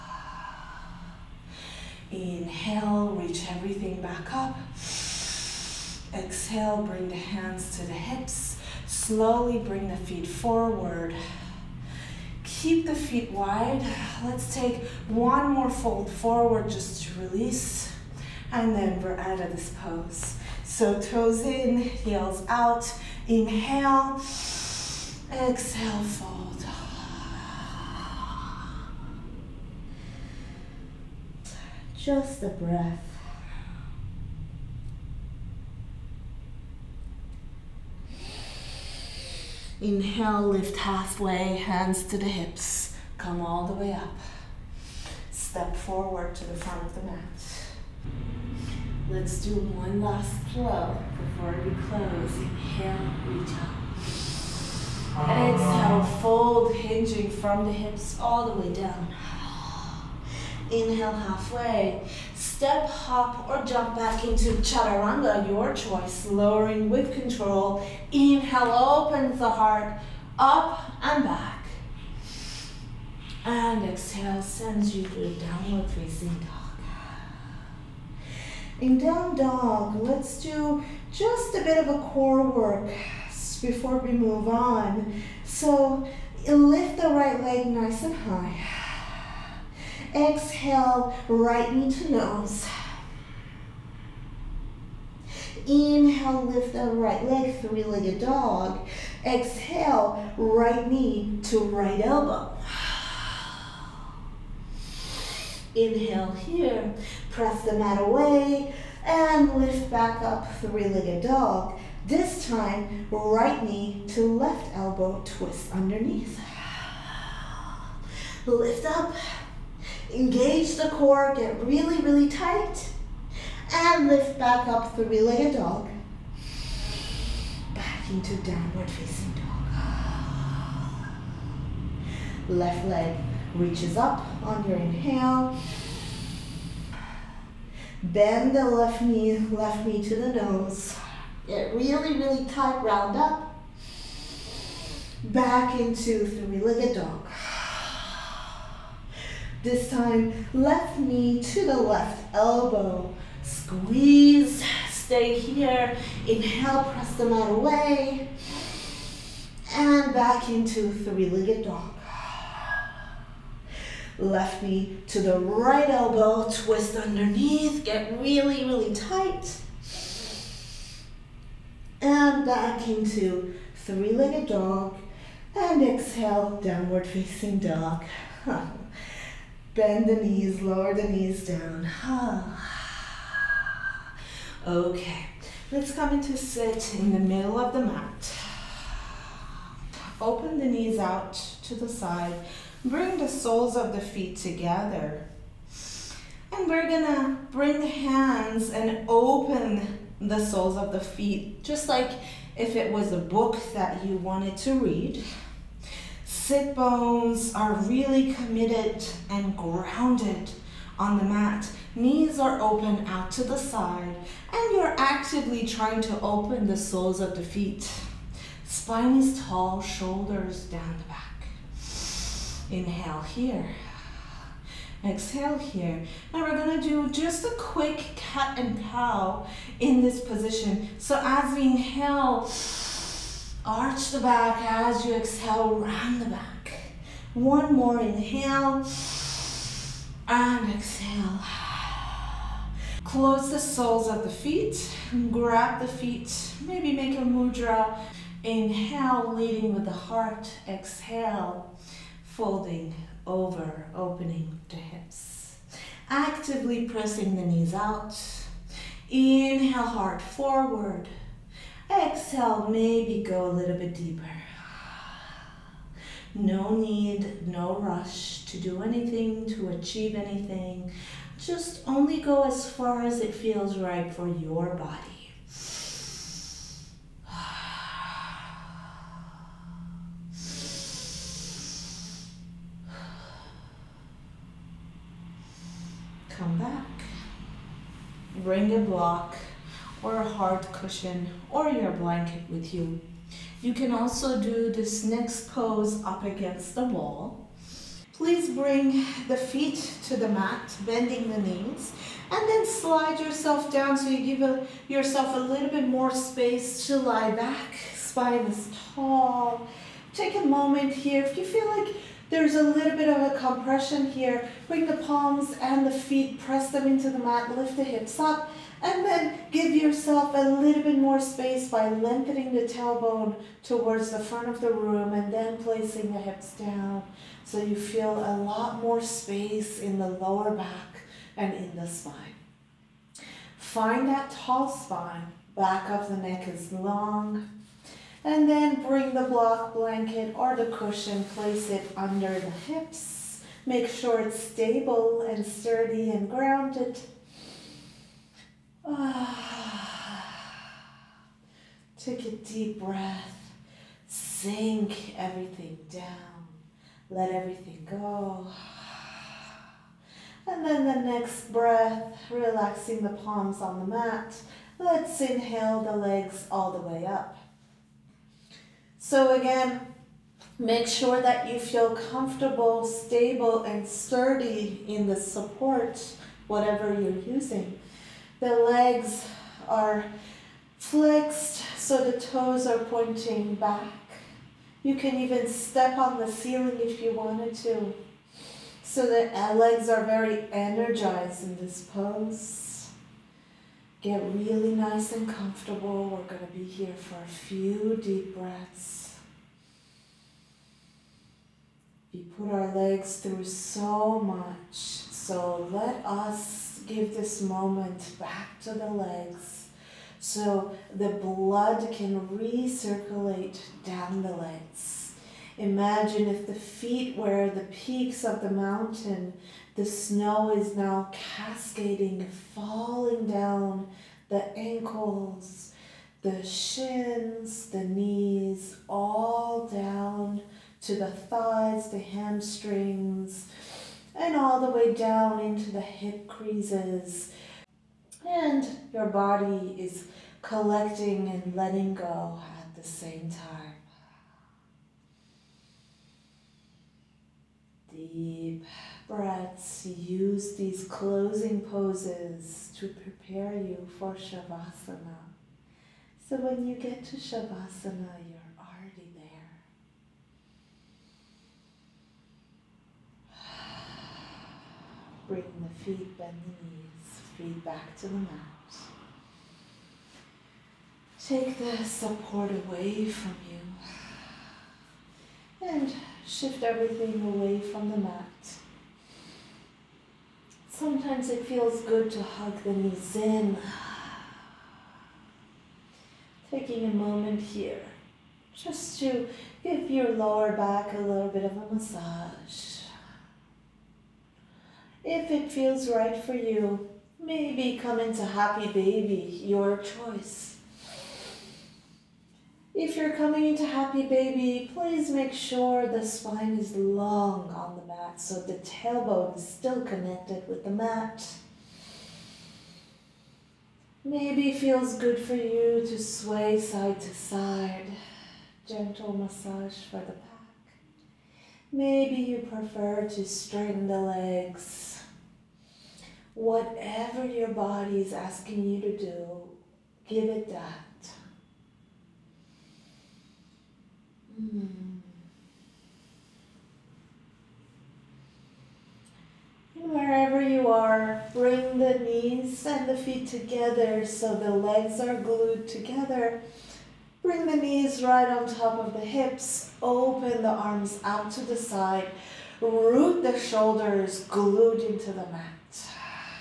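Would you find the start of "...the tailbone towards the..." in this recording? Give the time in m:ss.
5:22.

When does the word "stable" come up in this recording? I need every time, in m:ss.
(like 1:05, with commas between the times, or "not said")
5:44, 6:12.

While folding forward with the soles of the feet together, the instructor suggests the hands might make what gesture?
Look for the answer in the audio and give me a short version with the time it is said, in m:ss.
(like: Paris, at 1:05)
Mudra, at 4:07.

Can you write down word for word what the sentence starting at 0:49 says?
Let's do one last flow before we close.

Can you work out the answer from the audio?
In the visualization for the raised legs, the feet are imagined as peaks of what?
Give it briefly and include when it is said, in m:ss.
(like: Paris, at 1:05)
The mountain, at 6:58.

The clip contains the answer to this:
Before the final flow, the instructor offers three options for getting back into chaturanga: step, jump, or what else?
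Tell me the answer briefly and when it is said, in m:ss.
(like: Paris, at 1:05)
Hop, at 1:02.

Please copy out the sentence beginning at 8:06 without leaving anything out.
Taking a moment here just to give your lower back a little bit of a massage.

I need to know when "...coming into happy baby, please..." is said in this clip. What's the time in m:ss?
8:23.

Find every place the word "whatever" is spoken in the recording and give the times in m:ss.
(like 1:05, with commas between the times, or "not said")
6:16, 8:46.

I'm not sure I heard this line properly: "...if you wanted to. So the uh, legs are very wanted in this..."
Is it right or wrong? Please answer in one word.
wrong.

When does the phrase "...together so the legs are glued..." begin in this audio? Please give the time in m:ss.
9:03.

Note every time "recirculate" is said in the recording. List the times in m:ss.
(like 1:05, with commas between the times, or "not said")
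6:52.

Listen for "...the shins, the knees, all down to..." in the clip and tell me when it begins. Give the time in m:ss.
7:06.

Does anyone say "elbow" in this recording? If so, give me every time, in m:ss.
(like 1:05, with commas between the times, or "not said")
1:42, 1:54, 2:32, 2:45.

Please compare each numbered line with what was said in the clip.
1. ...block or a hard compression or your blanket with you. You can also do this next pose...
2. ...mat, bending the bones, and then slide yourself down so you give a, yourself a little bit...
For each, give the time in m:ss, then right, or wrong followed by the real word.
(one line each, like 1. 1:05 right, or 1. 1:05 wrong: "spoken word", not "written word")
1. 4:48 wrong: "cushion", not "compression"
2. 5:00 wrong: "knees", not "bones".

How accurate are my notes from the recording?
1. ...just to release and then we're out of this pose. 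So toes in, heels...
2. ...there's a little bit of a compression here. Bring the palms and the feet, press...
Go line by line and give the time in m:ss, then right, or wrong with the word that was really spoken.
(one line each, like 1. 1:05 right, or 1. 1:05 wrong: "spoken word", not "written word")
1. 0:16 right
2. 5:12 right.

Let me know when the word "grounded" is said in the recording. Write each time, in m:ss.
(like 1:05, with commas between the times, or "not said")
3:29, 5:46.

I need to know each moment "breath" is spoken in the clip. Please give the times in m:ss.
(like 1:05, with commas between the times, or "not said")
0:32, 5:52, 6:01, 6:38, 7:29.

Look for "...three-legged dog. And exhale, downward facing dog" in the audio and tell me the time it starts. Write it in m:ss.
2:53.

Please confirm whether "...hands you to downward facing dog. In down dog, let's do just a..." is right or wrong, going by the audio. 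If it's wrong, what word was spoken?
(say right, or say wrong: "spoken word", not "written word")
wrong: "sends", not "hands".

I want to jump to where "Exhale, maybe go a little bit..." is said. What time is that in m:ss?
4:21.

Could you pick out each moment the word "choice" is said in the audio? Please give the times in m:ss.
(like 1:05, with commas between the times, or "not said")
1:05, 8:19.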